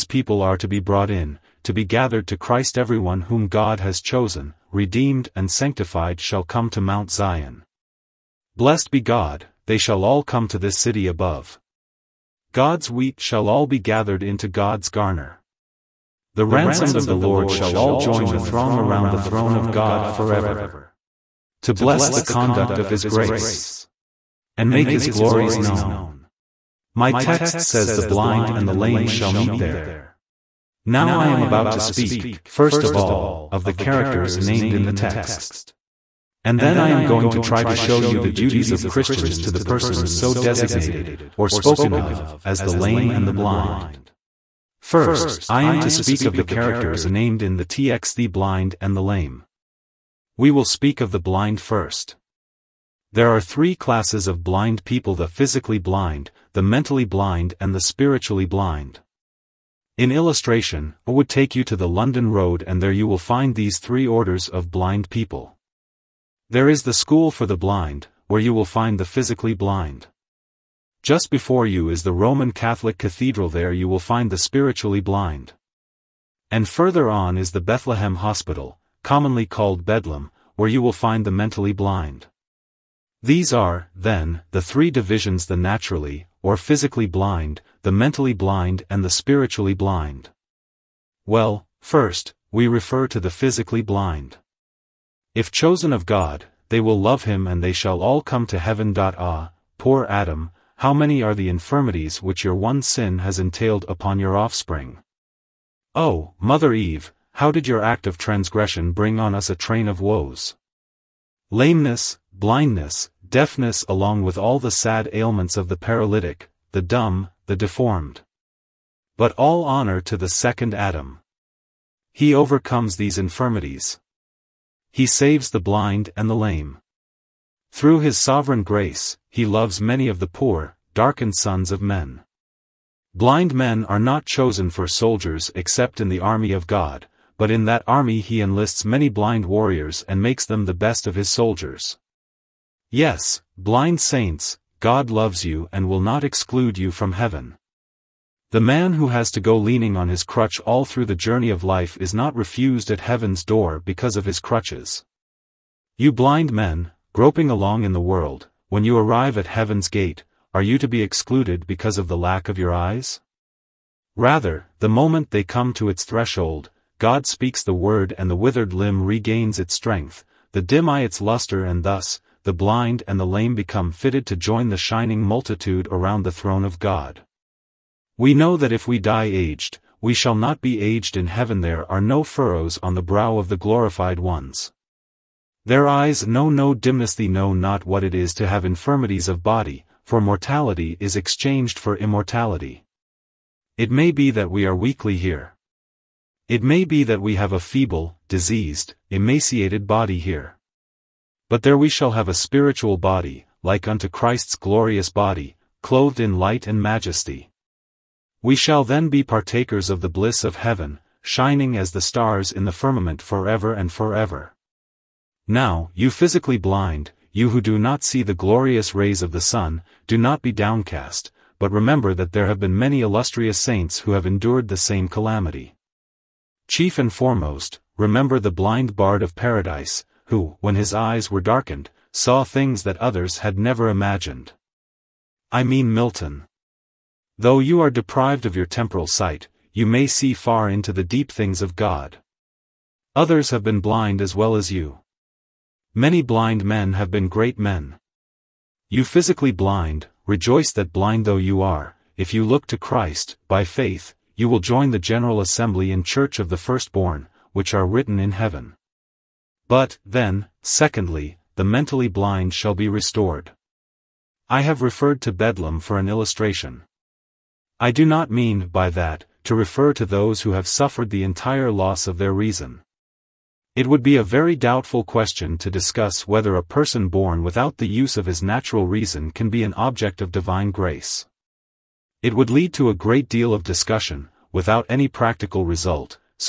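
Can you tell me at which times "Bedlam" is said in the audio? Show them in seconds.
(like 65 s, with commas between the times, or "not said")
79 s, 265 s.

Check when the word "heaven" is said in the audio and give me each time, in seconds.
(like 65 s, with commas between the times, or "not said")
98 s, 147 s, 152 s, 159 s, 181 s, 210 s, 258 s.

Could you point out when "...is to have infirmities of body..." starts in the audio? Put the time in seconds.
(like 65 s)
188 s.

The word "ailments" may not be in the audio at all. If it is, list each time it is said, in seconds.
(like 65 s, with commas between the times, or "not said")
115 s.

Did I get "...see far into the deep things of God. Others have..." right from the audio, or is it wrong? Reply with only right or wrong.
right.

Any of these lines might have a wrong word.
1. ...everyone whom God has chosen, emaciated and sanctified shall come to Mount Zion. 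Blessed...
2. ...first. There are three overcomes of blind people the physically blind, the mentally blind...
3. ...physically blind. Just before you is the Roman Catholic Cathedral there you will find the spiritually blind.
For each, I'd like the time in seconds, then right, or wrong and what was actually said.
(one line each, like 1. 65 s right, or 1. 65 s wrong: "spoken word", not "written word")
1. 2 s wrong: "redeemed", not "emaciated"
2. 51 s wrong: "classes", not "overcomes"
3. 69 s right.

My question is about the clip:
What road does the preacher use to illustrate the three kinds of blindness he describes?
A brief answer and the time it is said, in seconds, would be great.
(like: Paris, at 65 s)
London Road, at 61 s.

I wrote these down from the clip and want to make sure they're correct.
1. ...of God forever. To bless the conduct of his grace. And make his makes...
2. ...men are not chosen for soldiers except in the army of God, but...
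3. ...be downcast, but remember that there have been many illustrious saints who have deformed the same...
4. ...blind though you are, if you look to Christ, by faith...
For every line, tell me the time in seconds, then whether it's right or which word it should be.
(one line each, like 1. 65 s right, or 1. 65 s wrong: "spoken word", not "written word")
1. 19 s wrong: "glories", not "makes"
2. 133 s right
3. 220 s wrong: "endured", not "deformed"
4. 250 s right.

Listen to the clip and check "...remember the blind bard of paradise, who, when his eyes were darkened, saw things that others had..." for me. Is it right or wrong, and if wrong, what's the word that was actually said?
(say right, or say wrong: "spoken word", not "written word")
right.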